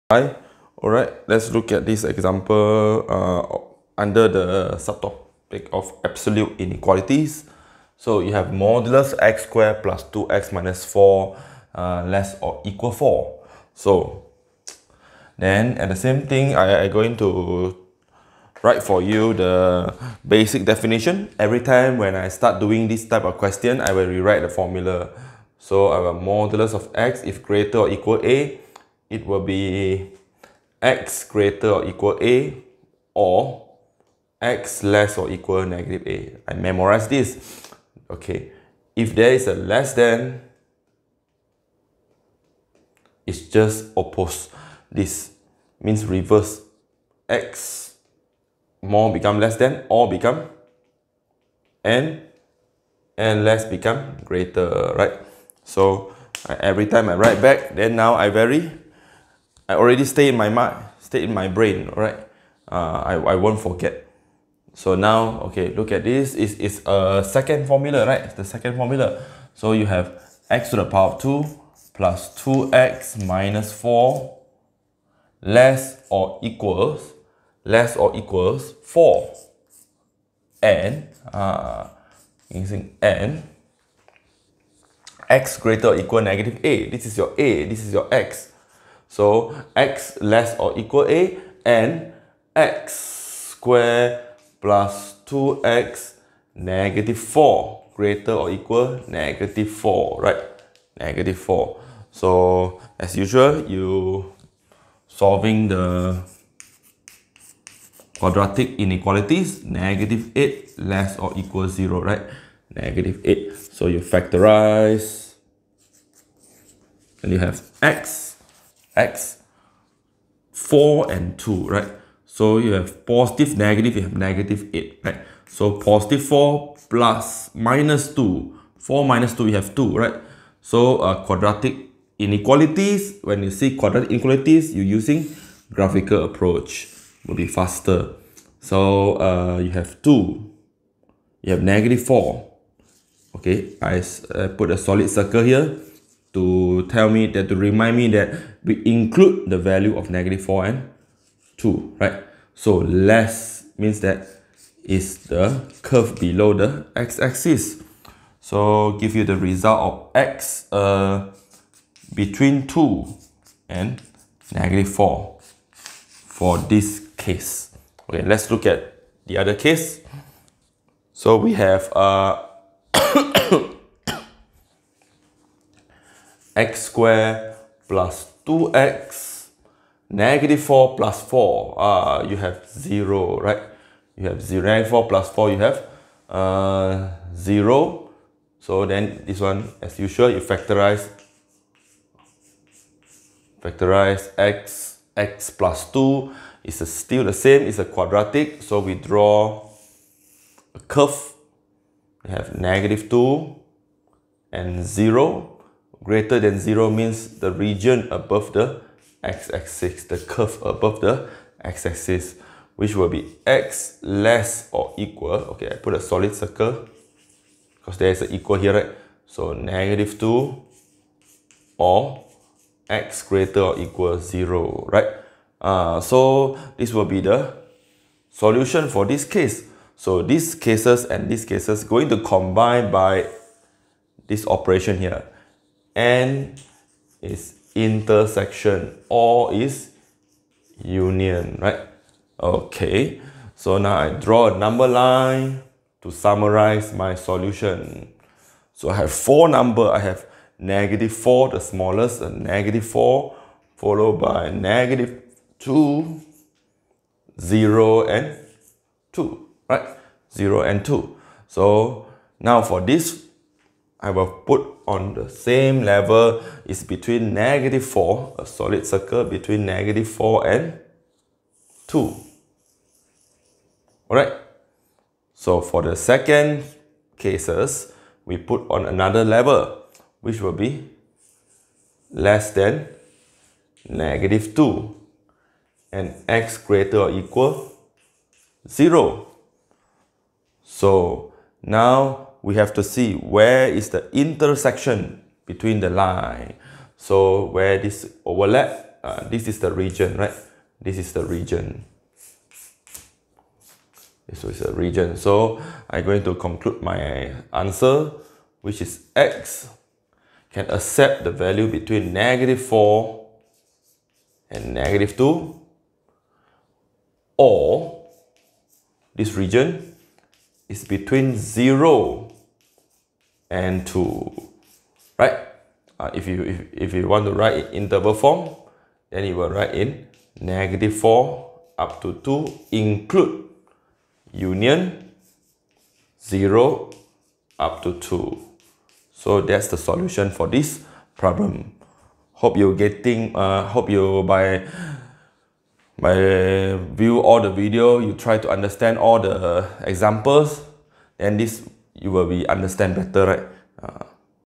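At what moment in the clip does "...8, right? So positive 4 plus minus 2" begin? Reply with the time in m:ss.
2:04.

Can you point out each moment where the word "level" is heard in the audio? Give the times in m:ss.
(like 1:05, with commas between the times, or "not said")
4:25, 4:39.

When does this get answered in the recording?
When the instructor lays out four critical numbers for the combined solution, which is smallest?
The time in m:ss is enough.
4:10.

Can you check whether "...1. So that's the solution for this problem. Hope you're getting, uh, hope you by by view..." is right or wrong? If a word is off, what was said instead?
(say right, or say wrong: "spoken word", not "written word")
wrong: "2", not "1".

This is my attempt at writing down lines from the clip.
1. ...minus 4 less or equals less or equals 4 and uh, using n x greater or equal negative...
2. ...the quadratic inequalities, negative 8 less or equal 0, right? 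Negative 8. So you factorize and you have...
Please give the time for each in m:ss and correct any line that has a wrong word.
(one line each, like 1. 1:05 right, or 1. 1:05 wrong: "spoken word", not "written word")
1. 1:13 right
2. 1:45 right.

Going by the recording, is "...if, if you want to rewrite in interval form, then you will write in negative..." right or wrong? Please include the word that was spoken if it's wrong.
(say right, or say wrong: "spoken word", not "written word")
wrong: "write", not "rewrite".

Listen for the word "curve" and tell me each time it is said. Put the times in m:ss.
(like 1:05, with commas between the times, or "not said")
2:35, 3:20, 3:30.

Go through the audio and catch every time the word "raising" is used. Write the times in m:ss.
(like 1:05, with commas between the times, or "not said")
not said.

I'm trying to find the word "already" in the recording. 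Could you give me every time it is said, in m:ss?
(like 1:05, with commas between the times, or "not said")
0:59.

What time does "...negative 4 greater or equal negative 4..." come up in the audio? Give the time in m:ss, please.
1:36.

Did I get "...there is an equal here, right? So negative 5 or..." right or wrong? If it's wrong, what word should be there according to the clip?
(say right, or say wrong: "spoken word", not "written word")
wrong: "2", not "5".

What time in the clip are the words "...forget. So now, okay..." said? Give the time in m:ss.
1:03.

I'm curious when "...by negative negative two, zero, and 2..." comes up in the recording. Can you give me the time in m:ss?
4:14.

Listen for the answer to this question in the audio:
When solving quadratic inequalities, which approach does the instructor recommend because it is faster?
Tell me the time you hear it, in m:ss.
2:15.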